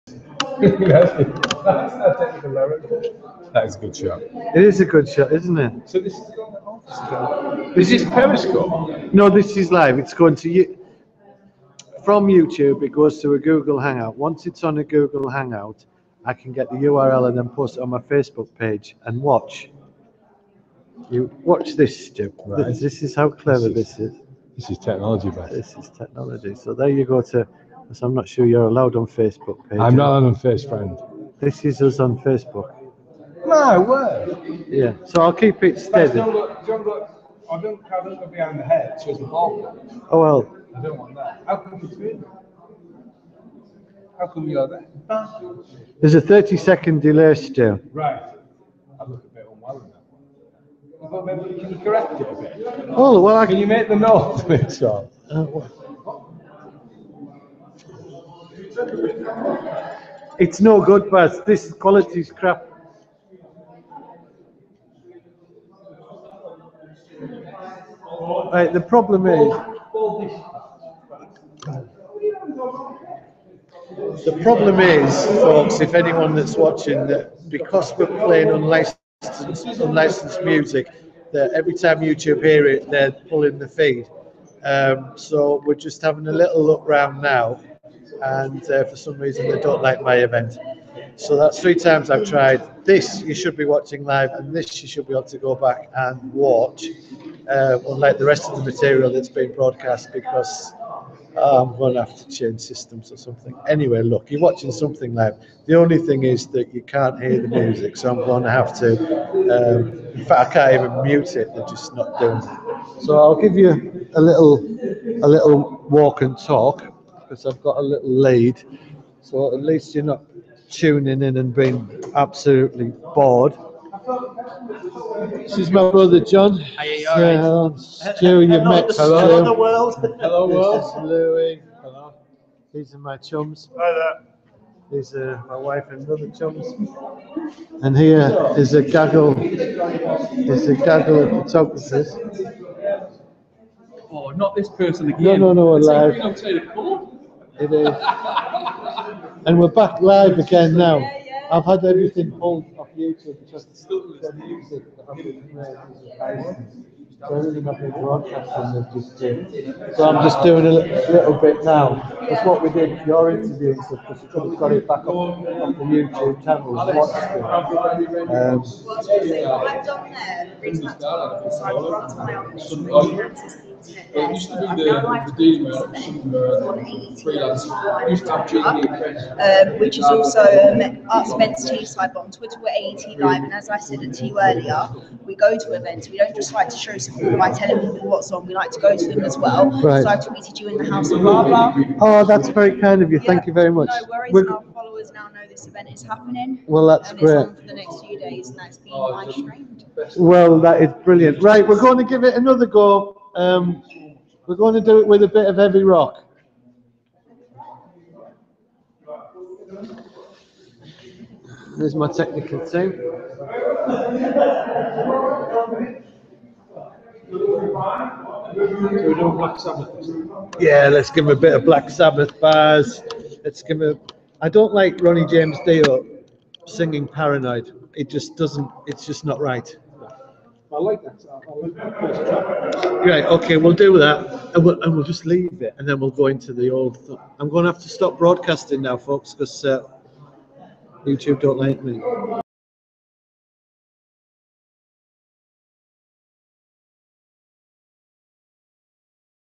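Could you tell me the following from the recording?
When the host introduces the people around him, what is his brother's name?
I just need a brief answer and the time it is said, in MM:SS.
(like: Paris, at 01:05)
John, at 02:06.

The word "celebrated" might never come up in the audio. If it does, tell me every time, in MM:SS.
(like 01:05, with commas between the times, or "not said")
not said.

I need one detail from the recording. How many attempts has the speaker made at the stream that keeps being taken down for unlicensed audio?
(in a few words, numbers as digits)
3.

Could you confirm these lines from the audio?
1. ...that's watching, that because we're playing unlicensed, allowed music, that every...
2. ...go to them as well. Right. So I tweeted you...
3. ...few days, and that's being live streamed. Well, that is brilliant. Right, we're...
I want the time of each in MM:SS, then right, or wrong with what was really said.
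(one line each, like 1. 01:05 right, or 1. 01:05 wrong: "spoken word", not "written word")
1. 01:16 wrong: "unlicensed", not "allowed"
2. 03:08 right
3. 03:18 right.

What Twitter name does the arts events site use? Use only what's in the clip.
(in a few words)
AET Live.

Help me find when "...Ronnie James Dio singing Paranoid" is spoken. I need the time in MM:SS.
03:45.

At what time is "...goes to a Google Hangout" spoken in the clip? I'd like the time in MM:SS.
00:12.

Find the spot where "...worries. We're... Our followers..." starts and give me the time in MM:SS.
03:14.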